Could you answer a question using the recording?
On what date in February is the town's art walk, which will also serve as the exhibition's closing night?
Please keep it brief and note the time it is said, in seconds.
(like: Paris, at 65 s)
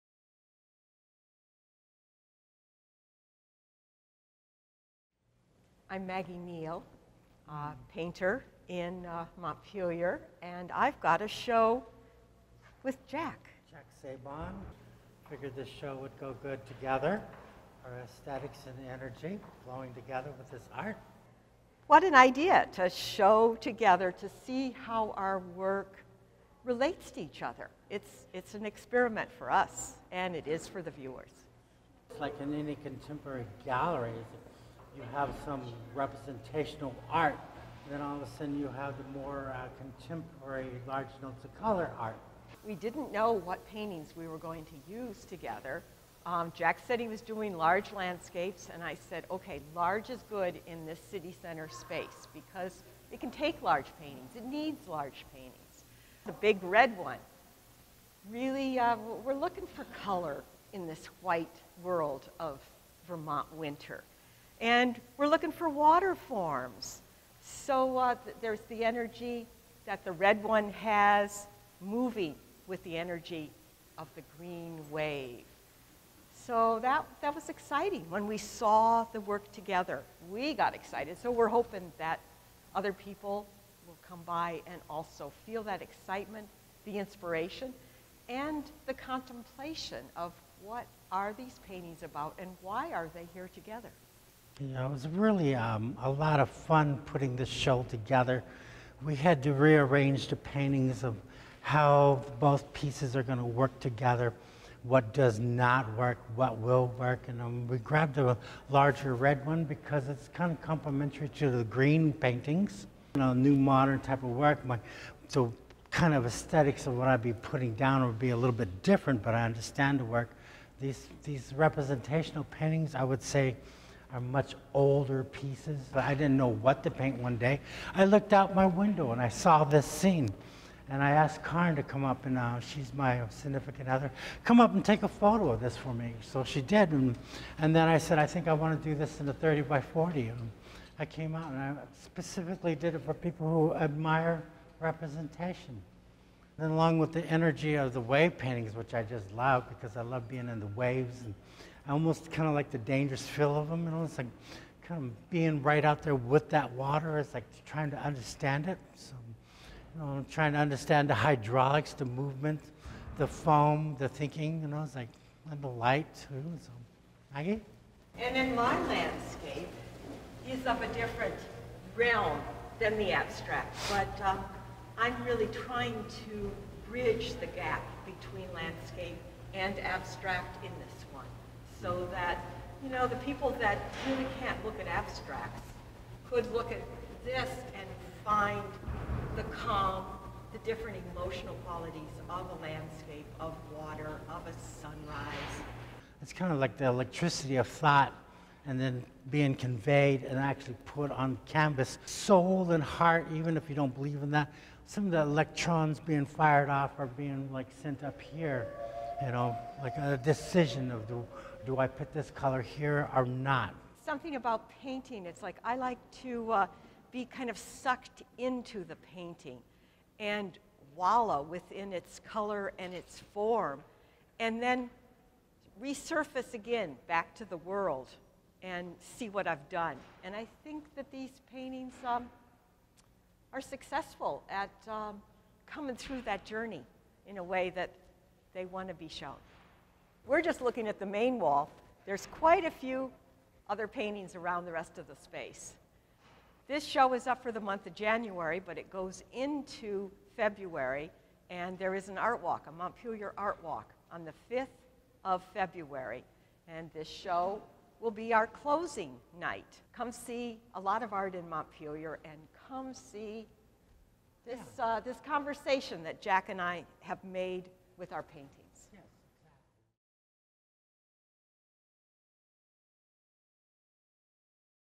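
February 5, at 254 s.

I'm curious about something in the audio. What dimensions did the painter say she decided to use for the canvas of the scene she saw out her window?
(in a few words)
30 by 40.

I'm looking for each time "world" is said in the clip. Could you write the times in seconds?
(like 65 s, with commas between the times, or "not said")
61 s, 227 s.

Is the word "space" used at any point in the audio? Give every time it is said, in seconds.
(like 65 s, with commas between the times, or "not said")
51 s, 245 s.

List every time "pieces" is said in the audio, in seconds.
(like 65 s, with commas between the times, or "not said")
102 s, 125 s.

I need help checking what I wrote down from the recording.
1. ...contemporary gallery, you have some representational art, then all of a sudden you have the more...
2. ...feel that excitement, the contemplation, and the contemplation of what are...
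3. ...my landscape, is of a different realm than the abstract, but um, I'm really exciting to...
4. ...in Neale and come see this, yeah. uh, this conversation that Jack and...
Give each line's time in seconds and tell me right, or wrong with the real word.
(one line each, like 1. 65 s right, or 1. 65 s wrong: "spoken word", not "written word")
1. 32 s right
2. 85 s wrong: "inspiration", not "contemplation"
3. 168 s wrong: "trying", not "exciting"
4. 261 s wrong: "Montpelier", not "Neale".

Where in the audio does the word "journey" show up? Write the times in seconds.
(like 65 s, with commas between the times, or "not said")
236 s.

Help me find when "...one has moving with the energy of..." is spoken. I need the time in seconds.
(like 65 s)
70 s.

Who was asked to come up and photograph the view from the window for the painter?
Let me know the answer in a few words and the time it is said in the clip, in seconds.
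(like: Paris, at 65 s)
Karen, at 131 s.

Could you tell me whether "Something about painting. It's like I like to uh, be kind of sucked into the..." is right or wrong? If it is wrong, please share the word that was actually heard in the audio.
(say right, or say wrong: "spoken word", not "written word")
right.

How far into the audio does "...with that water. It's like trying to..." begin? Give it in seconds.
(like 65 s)
156 s.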